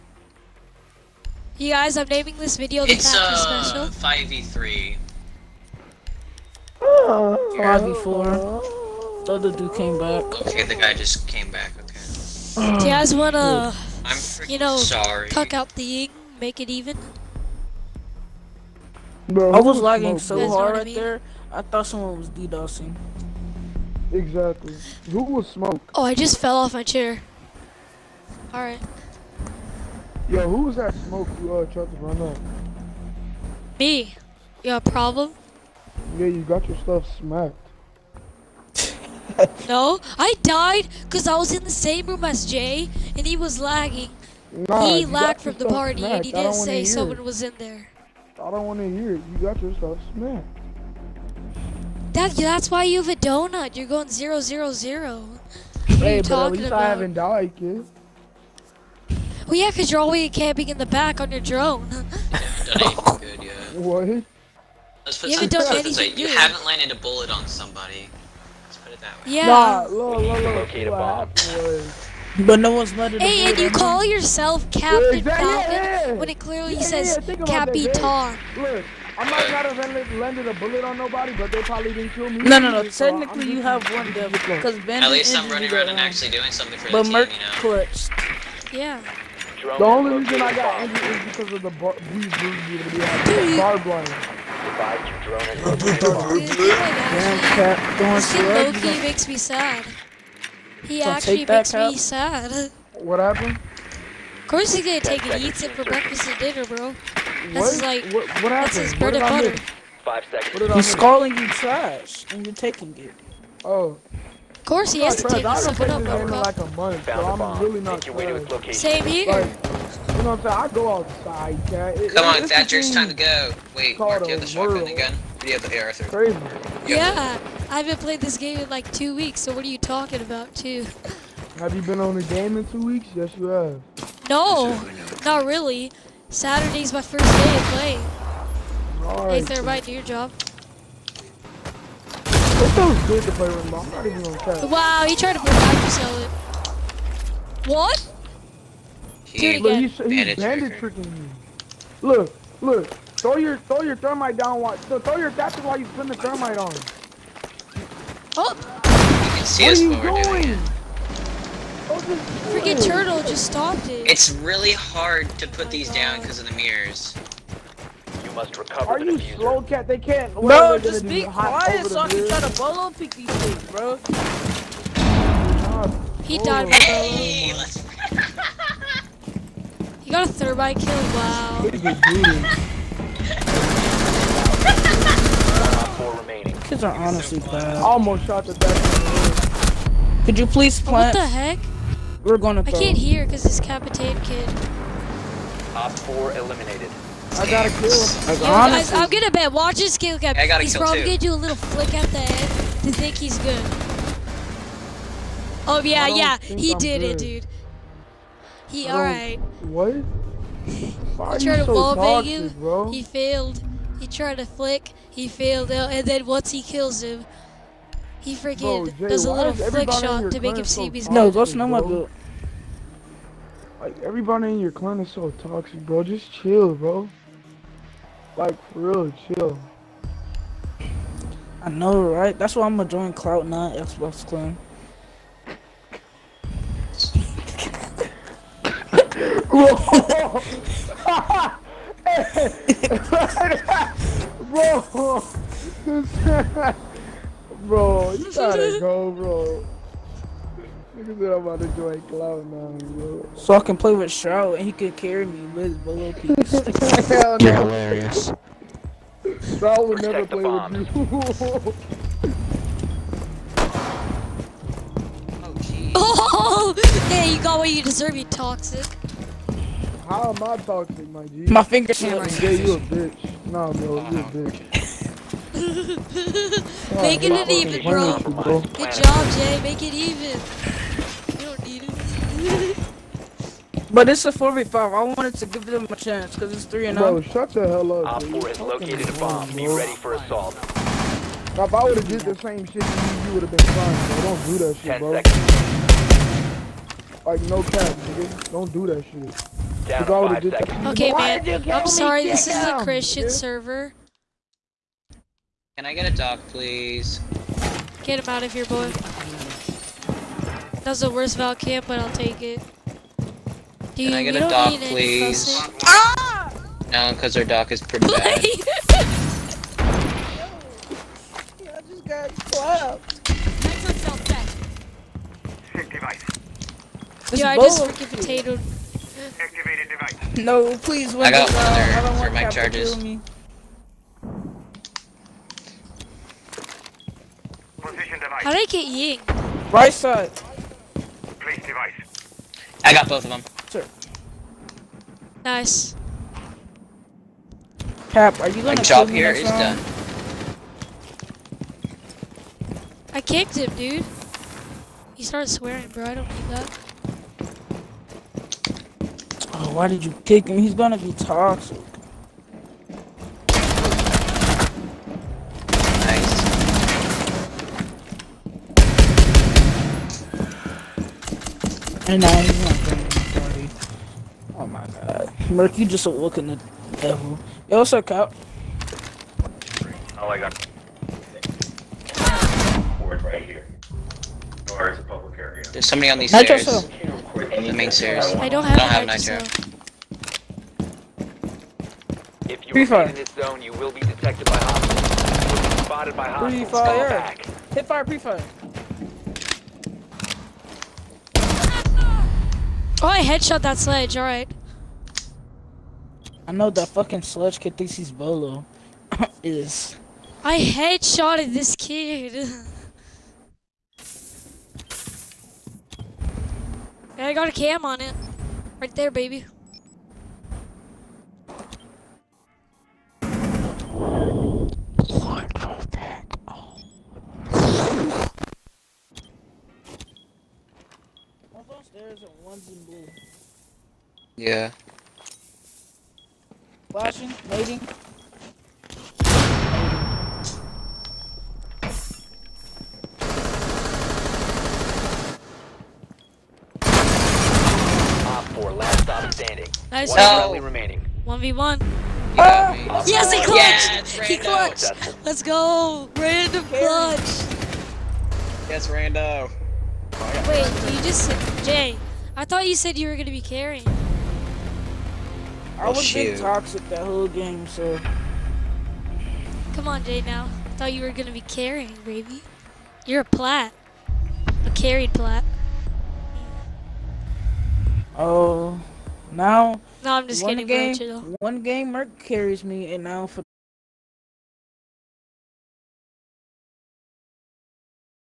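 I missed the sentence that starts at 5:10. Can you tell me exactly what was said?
That's the worst Val camp, but I'll take it.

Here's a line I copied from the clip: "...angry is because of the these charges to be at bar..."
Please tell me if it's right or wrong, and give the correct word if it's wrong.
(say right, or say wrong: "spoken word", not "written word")
wrong: "dudes", not "charges".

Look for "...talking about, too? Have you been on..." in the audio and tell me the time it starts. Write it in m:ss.
2:09.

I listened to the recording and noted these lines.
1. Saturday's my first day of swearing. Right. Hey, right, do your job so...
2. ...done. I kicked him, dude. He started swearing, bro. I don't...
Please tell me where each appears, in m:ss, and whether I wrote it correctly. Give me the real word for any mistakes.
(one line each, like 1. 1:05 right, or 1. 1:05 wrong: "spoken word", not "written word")
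1. 2:16 wrong: "playing", not "swearing"
2. 5:49 right.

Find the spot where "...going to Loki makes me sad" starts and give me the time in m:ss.
1:37.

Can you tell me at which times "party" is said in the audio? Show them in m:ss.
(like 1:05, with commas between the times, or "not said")
0:45.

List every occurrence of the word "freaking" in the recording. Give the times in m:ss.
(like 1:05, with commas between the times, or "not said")
2:42, 3:38, 5:27.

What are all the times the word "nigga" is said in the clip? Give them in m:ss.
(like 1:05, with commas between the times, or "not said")
4:10, 4:58.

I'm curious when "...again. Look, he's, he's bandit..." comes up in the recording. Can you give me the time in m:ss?
2:29.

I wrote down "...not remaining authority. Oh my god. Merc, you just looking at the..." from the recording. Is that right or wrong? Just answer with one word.
wrong.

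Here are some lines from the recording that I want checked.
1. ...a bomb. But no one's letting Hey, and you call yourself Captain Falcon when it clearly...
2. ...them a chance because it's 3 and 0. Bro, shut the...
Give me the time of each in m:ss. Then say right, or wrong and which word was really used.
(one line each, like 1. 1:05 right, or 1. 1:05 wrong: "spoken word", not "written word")
1. 1:10 right
2. 4:45 right.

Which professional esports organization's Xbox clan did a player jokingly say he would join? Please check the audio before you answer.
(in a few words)
Cloud9.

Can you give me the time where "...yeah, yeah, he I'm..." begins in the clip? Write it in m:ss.
3:25.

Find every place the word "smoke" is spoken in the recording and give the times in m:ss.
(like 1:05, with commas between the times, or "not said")
0:25, 0:31.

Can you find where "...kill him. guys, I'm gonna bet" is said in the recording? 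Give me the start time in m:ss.
3:17.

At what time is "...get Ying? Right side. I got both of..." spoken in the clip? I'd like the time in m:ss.
5:38.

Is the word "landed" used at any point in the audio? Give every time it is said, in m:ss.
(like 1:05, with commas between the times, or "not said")
1:06, 1:20.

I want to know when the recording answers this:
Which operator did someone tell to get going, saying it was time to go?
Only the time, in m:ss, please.
2:02.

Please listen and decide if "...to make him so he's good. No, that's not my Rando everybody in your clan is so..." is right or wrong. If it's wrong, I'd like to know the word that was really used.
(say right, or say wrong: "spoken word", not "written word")
wrong: "Like", not "Rando".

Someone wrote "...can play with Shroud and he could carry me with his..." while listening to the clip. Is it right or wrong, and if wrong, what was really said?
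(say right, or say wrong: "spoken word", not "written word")
right.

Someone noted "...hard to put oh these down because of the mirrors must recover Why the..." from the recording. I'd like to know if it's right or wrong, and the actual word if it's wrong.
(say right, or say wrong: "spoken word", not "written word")
wrong: "Are", not "Why".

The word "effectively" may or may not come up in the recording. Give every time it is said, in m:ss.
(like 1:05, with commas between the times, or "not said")
not said.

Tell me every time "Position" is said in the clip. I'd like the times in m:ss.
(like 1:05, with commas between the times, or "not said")
5:32.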